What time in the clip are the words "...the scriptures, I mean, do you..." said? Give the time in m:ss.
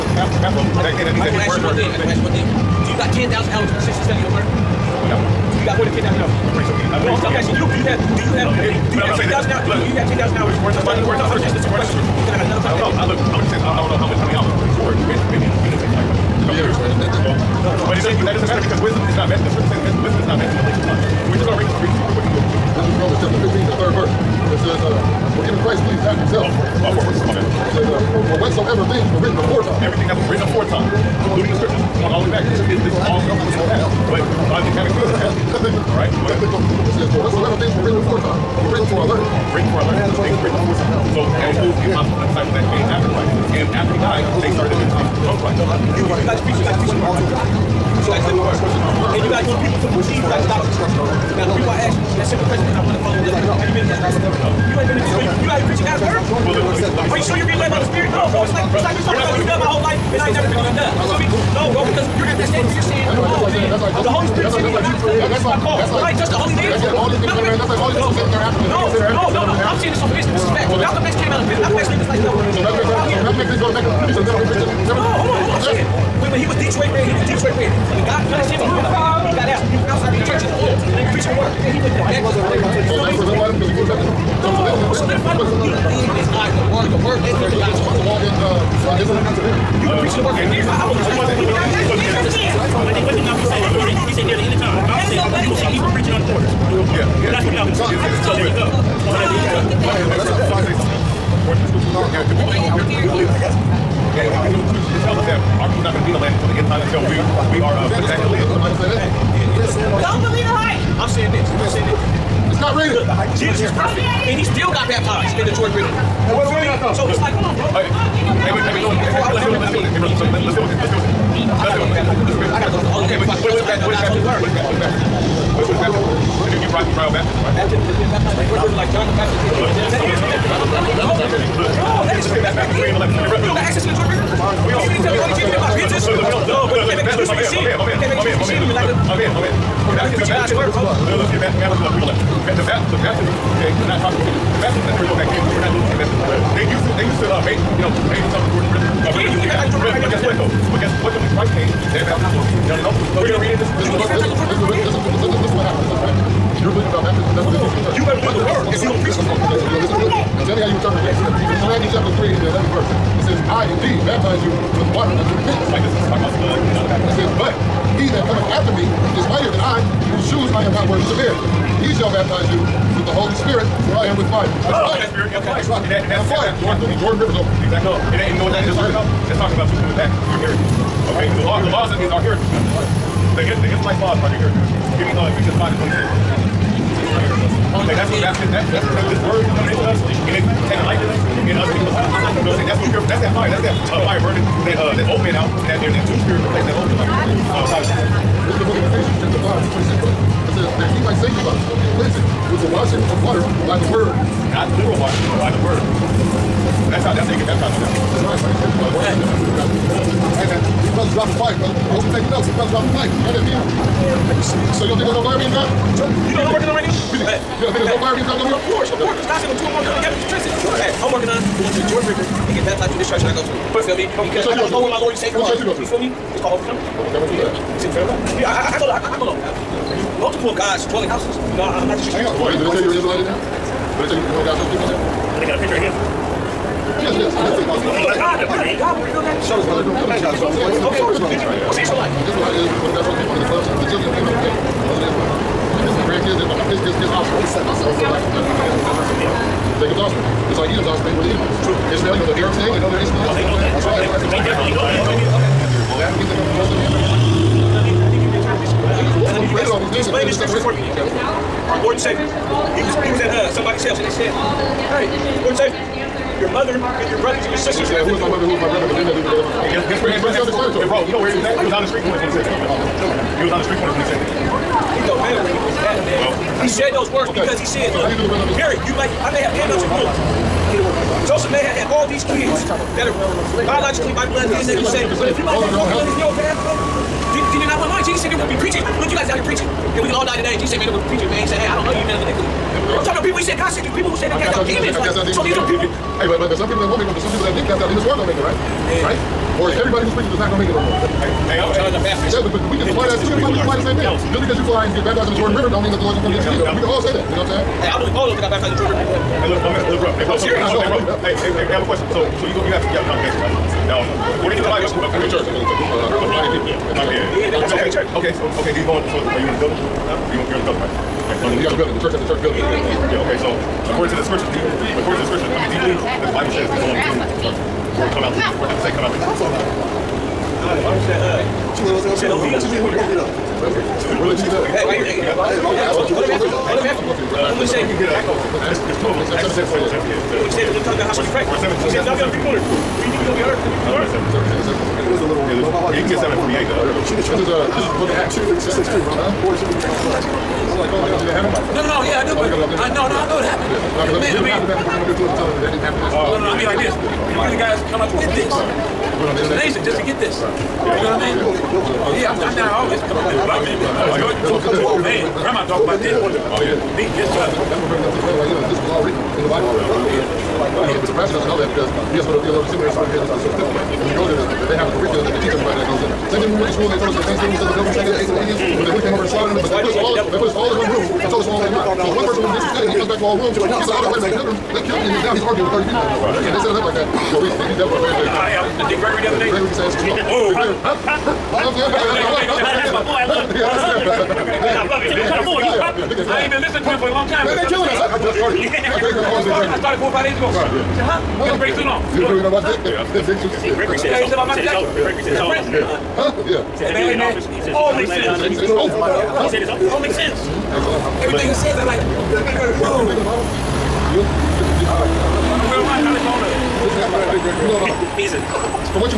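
5:25.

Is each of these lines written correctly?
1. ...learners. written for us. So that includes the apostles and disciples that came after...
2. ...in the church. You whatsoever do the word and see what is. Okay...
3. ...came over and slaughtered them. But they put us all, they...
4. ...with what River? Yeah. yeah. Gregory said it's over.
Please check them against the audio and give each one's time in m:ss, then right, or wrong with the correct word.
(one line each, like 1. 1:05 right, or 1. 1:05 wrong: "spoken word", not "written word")
1. 0:39 right
2. 2:37 wrong: "better", not "whatsoever"
3. 6:19 right
4. 6:42 wrong: "Dick", not "River".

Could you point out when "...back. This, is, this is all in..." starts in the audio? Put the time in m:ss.
0:32.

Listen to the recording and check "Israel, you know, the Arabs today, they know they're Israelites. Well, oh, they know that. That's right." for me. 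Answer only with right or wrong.
right.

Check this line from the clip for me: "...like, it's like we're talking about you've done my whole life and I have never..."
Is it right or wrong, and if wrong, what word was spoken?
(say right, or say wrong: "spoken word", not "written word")
right.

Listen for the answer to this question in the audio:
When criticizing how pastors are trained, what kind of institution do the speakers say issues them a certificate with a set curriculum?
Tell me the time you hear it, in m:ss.
6:12.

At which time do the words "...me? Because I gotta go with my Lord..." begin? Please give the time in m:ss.
3:43.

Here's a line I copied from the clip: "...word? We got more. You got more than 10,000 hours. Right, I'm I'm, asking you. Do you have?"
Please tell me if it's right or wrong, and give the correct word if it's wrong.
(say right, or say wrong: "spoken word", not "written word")
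right.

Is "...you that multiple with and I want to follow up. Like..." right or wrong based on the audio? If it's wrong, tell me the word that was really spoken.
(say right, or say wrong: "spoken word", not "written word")
wrong: "simple", not "multiple".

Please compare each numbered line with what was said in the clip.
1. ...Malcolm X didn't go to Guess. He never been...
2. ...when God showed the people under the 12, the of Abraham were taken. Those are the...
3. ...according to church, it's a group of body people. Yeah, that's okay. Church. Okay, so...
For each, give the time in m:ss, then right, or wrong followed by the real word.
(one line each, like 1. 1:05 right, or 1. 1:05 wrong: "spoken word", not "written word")
1. 1:13 wrong: "Mecca", not "Guess"
2. 4:02 right
3. 5:14 right.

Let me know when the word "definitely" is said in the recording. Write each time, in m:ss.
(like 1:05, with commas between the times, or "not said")
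4:14, 6:27.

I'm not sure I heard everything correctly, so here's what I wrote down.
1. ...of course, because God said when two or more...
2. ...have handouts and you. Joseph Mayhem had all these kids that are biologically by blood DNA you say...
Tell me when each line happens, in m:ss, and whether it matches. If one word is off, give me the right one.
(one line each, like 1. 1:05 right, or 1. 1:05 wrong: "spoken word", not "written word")
1. 3:38 right
2. 4:39 right.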